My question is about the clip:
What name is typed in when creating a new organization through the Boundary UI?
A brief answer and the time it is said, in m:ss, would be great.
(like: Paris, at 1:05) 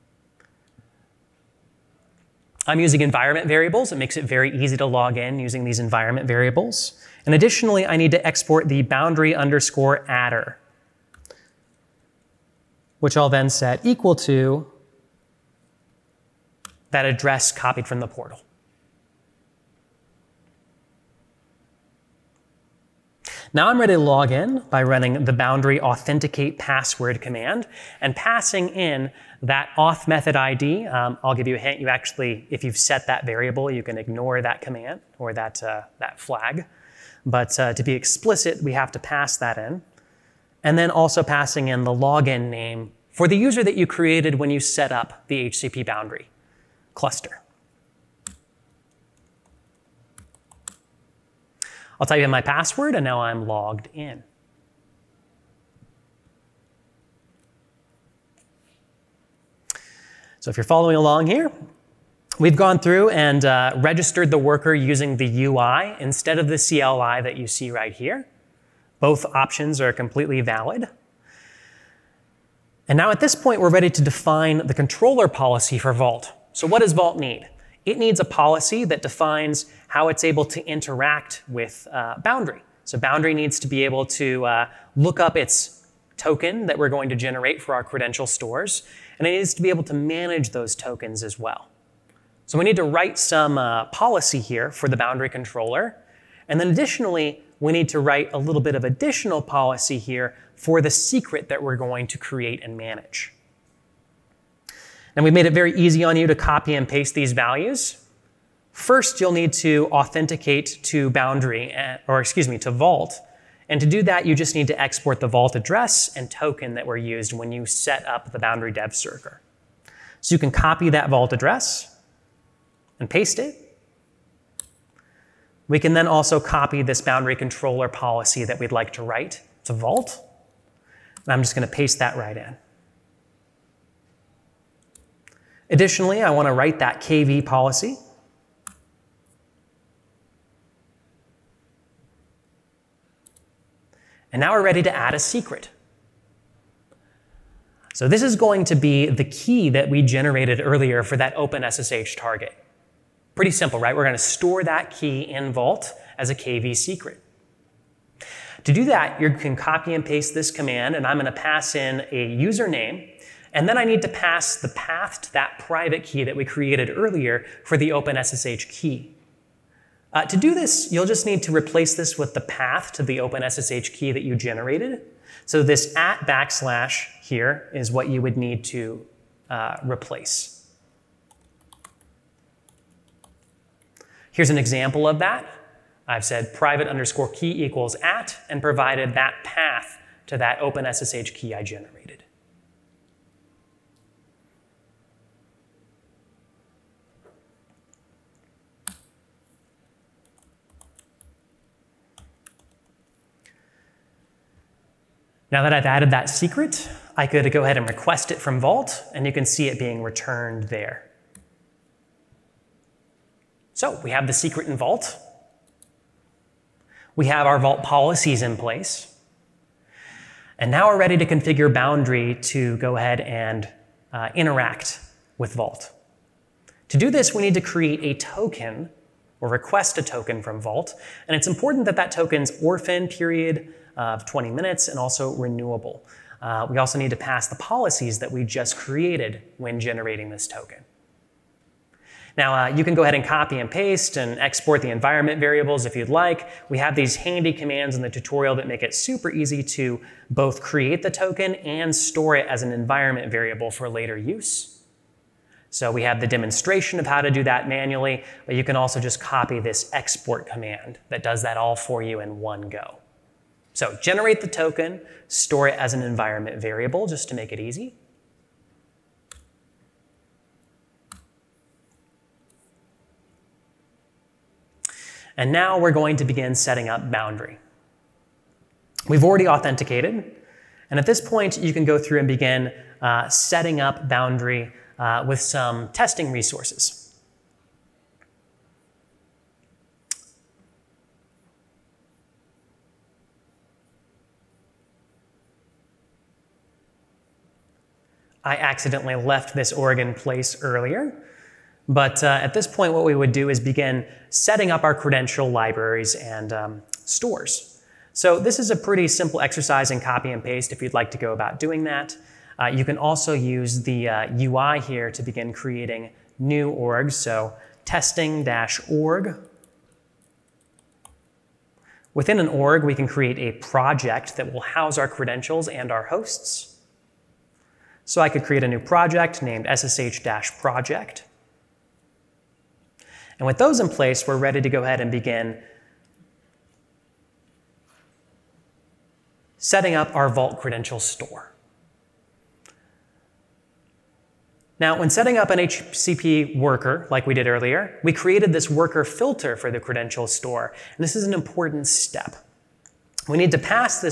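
testing-org, at 5:17.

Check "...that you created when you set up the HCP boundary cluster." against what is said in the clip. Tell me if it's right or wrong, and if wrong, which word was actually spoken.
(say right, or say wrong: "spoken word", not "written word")
right.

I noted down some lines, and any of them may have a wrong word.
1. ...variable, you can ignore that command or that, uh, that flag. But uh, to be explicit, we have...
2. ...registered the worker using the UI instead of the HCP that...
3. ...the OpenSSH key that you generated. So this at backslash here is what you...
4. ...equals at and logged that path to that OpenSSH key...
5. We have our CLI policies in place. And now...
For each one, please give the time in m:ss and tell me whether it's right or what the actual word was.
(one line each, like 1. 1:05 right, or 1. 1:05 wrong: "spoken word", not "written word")
1. 0:33 right
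2. 1:03 wrong: "CLI", not "HCP"
3. 2:53 right
4. 3:07 wrong: "provided", not "logged"
5. 3:37 wrong: "Vault", not "CLI".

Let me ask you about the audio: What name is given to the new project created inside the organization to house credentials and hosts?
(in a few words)
ssh-project.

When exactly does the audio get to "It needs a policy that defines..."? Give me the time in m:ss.
1:17.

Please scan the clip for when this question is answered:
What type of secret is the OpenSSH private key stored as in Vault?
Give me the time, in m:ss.
2:36.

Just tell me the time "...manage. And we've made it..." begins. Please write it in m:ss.
1:42.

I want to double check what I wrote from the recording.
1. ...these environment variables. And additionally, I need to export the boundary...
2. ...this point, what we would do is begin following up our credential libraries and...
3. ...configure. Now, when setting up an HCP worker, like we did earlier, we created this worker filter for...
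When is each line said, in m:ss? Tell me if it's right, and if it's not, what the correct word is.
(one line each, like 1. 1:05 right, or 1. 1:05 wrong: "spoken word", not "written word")
1. 0:05 right
2. 5:02 wrong: "setting", not "following"
3. 5:40 wrong: "store", not "configure".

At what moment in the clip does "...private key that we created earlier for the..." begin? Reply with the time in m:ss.
2:45.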